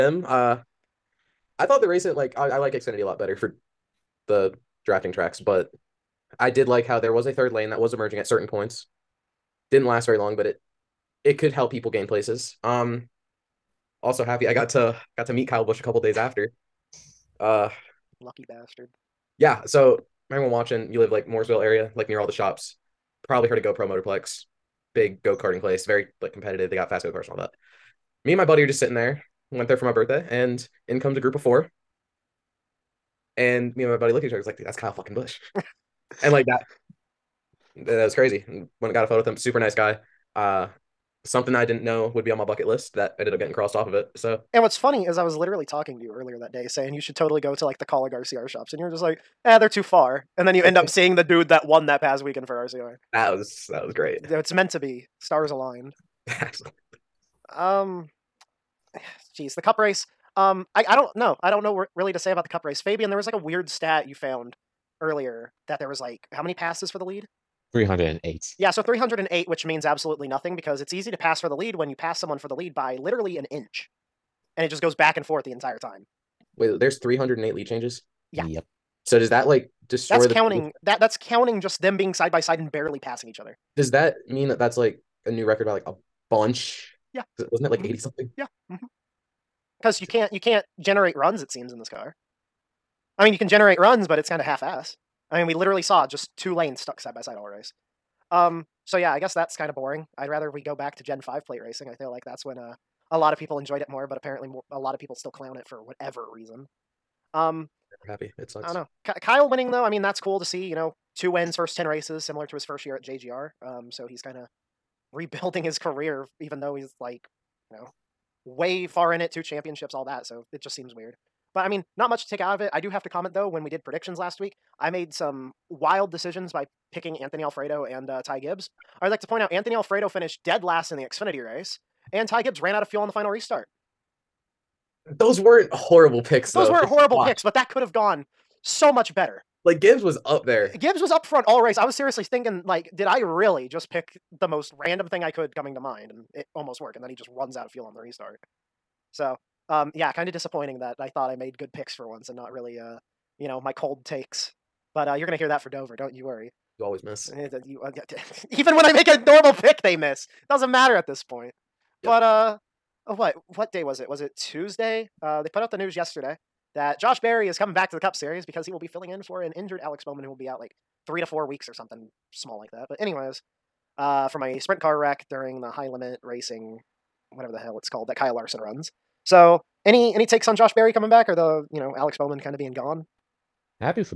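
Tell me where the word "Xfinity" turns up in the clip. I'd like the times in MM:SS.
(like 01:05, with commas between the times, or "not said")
00:02, 02:11.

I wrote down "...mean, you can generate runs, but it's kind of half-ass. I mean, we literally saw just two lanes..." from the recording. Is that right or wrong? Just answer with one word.
right.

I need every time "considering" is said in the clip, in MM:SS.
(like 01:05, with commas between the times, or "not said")
not said.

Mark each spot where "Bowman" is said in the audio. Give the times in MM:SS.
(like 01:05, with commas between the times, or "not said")
02:50, 03:02.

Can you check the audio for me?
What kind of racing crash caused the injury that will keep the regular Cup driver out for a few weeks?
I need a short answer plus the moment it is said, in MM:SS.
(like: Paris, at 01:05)
Sprint car wreck, at 02:54.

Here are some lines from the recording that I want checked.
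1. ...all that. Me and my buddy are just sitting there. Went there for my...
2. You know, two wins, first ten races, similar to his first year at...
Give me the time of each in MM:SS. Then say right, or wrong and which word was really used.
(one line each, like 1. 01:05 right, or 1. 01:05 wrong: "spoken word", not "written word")
1. 00:27 right
2. 01:50 right.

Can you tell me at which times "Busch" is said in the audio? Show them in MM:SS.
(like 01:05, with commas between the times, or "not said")
00:15, 00:35.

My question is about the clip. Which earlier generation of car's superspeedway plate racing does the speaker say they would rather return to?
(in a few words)
Gen Five.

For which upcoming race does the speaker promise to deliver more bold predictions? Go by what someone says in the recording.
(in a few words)
Dover.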